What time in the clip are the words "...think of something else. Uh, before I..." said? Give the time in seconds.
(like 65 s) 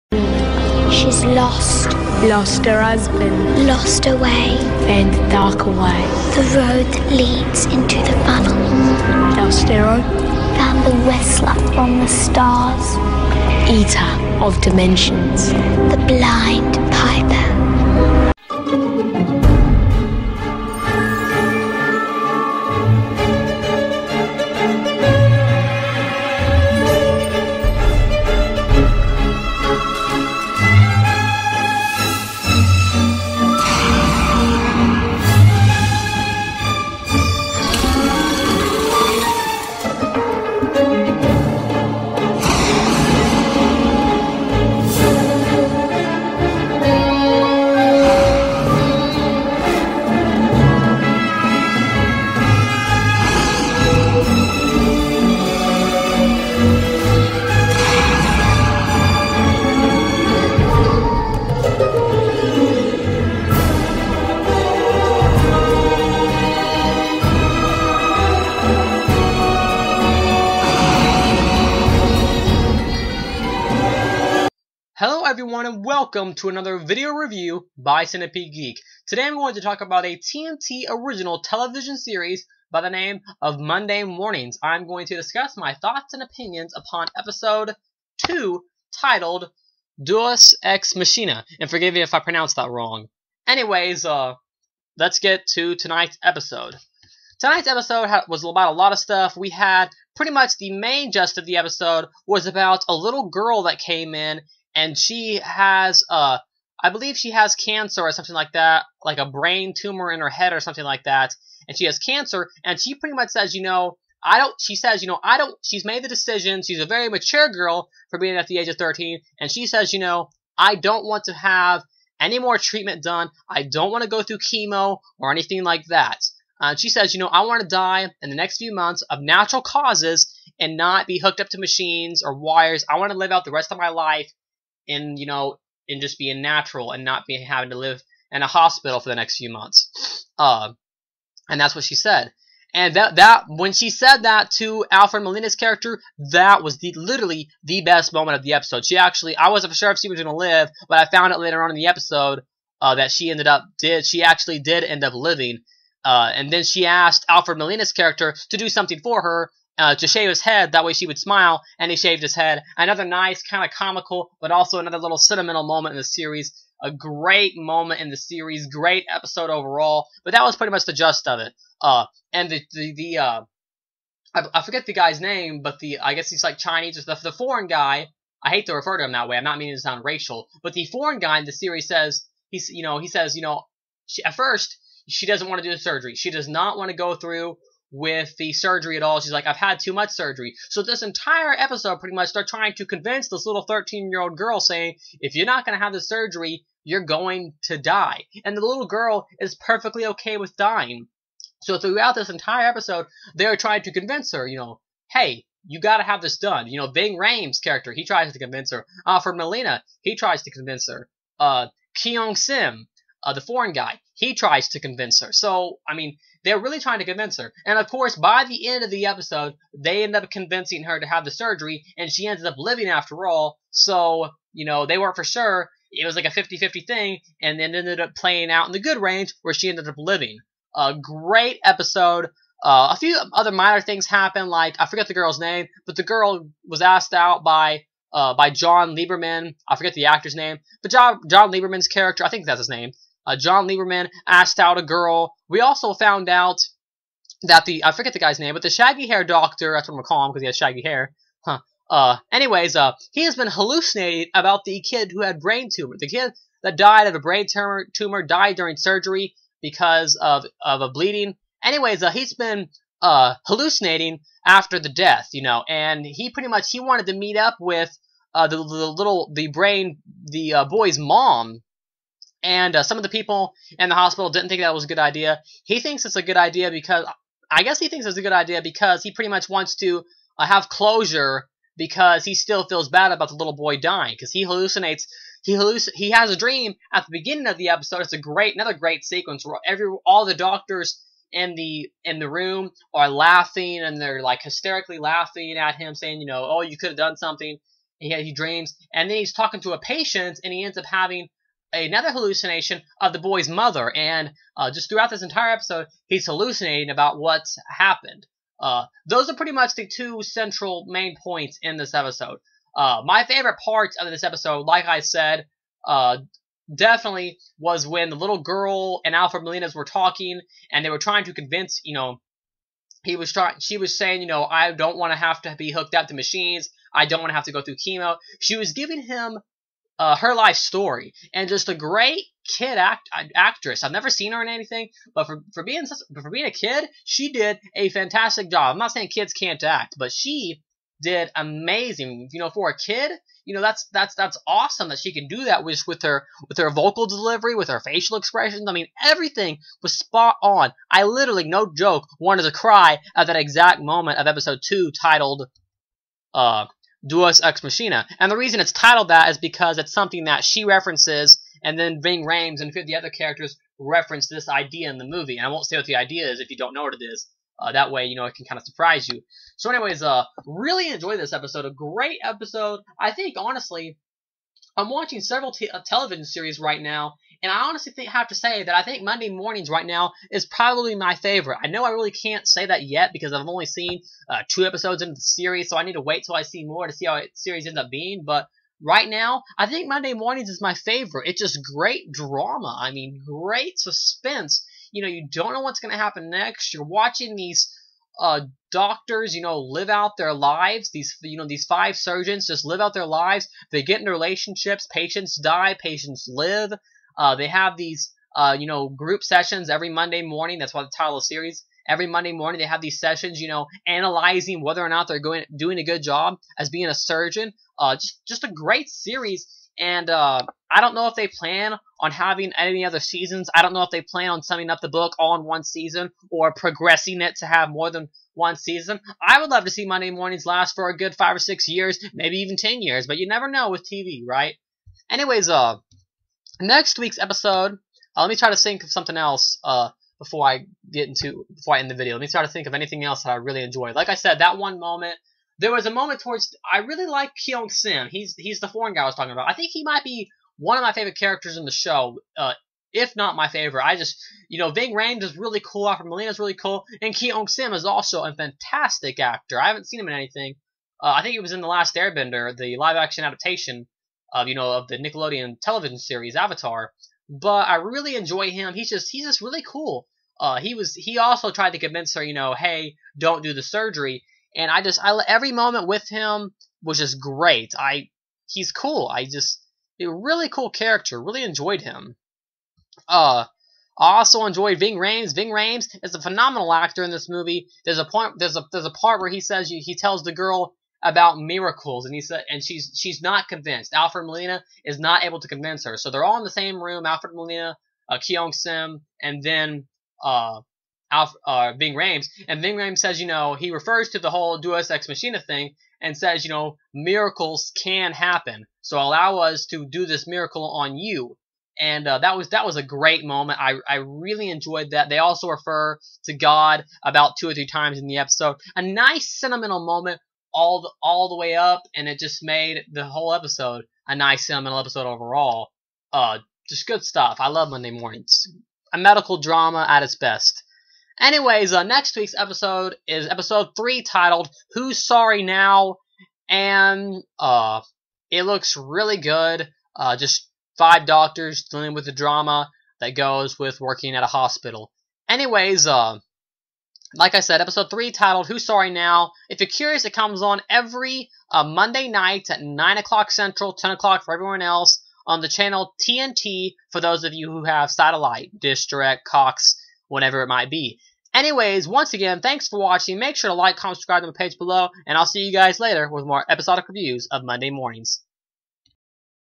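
438 s.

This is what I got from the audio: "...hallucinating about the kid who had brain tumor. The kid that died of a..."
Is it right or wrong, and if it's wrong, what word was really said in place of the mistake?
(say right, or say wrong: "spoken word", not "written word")
right.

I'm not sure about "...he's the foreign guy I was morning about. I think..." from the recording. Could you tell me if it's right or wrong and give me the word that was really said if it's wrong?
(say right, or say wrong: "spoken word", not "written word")
wrong: "talking", not "morning".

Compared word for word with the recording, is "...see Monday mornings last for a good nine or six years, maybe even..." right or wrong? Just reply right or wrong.
wrong.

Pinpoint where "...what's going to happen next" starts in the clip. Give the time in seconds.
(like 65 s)
395 s.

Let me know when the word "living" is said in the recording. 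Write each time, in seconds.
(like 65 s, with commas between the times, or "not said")
155 s, 222 s, 229 s.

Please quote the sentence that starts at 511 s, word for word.
And uh, that was that was a great moment.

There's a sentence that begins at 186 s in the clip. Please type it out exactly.
She does not want to go through with the surgery at all.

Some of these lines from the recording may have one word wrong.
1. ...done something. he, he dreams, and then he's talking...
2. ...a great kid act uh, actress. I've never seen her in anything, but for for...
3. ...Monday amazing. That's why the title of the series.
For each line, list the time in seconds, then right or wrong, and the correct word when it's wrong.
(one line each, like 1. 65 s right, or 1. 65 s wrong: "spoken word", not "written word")
1. 296 s right
2. 331 s right
3. 409 s wrong: "morning", not "amazing".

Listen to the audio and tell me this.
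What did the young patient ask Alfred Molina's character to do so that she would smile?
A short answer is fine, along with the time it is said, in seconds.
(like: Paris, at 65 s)
Shave his head, at 159 s.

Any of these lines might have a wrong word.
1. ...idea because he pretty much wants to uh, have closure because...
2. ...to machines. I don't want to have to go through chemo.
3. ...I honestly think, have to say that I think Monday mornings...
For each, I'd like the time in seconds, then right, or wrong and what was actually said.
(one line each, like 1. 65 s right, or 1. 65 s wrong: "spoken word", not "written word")
1. 278 s right
2. 326 s right
3. 377 s right.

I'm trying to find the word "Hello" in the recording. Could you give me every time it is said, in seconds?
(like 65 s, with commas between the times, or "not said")
75 s.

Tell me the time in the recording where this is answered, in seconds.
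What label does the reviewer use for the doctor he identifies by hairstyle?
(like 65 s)
248 s.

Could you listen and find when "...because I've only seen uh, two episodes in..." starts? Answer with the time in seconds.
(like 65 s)
383 s.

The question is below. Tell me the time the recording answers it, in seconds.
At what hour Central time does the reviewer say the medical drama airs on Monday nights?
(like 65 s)
552 s.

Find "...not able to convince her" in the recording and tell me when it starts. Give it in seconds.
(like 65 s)
494 s.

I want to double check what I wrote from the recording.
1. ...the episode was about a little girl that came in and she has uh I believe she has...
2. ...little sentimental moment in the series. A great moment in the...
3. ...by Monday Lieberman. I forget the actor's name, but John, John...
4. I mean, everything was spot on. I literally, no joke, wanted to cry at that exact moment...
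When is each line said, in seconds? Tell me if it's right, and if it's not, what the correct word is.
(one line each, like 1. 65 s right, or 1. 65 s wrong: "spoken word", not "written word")
1. 101 s right
2. 164 s right
3. 238 s wrong: "John", not "Monday"
4. 348 s right.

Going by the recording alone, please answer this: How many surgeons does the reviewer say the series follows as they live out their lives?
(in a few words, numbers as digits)
5.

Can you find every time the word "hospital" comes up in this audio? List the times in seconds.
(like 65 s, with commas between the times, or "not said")
138 s, 273 s, 544 s.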